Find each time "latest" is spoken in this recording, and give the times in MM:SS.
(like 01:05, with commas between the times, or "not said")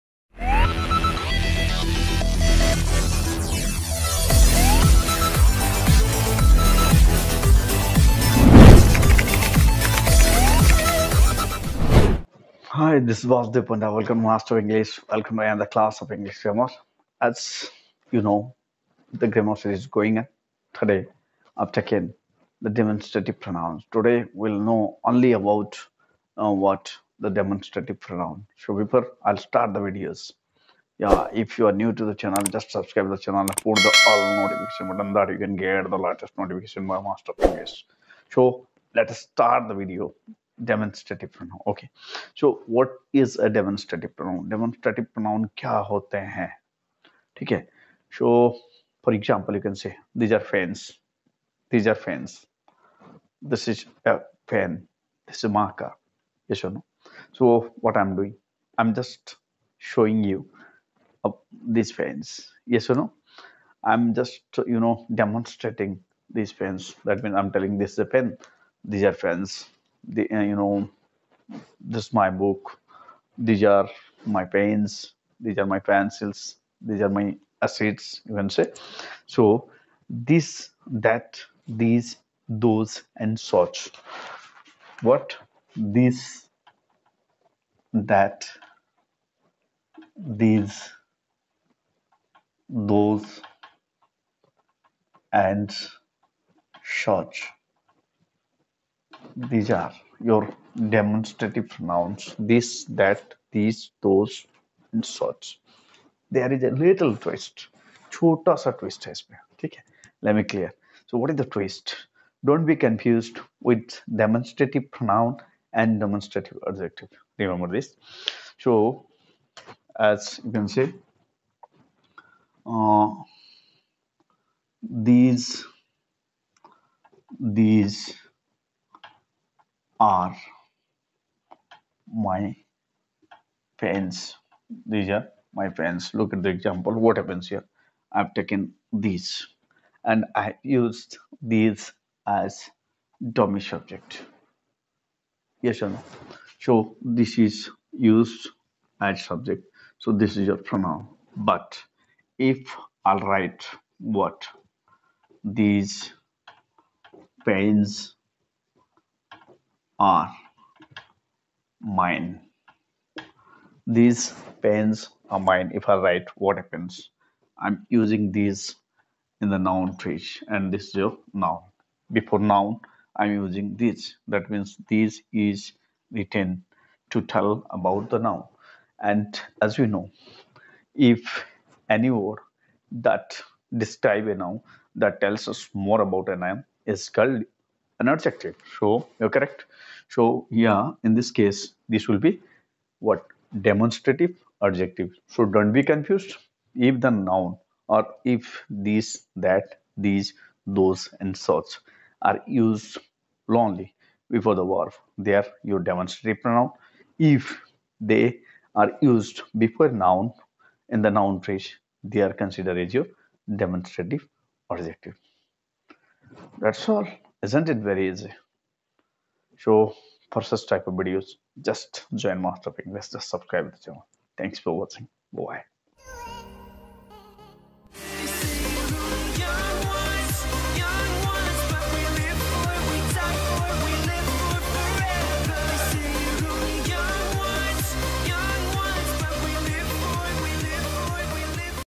00:35.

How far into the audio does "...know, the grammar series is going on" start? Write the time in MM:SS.
00:18.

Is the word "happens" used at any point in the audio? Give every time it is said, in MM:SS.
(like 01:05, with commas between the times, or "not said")
02:17, 02:46.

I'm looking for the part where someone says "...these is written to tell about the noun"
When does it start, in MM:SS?
02:54.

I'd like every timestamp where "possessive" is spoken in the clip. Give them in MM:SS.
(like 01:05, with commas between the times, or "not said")
not said.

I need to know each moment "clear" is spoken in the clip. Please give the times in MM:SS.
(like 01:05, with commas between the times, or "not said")
01:50.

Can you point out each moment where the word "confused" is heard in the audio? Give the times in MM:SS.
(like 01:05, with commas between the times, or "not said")
01:52, 03:15.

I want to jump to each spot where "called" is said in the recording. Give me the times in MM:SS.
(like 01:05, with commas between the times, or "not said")
03:07.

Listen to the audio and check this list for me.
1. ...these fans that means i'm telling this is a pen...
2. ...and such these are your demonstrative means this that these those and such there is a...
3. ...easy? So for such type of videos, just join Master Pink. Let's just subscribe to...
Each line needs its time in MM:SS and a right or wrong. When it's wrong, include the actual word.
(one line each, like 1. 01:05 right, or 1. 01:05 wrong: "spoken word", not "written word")
1. 01:06 right
2. 01:35 wrong: "pronouns", not "means"
3. 03:38 right.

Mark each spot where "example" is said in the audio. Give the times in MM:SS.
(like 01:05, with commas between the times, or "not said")
00:49, 02:16.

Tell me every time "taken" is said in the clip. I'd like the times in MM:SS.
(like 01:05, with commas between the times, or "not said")
00:21, 02:18.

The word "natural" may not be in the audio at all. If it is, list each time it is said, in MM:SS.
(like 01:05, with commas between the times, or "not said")
not said.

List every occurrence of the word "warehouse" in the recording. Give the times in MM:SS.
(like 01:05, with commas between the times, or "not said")
not said.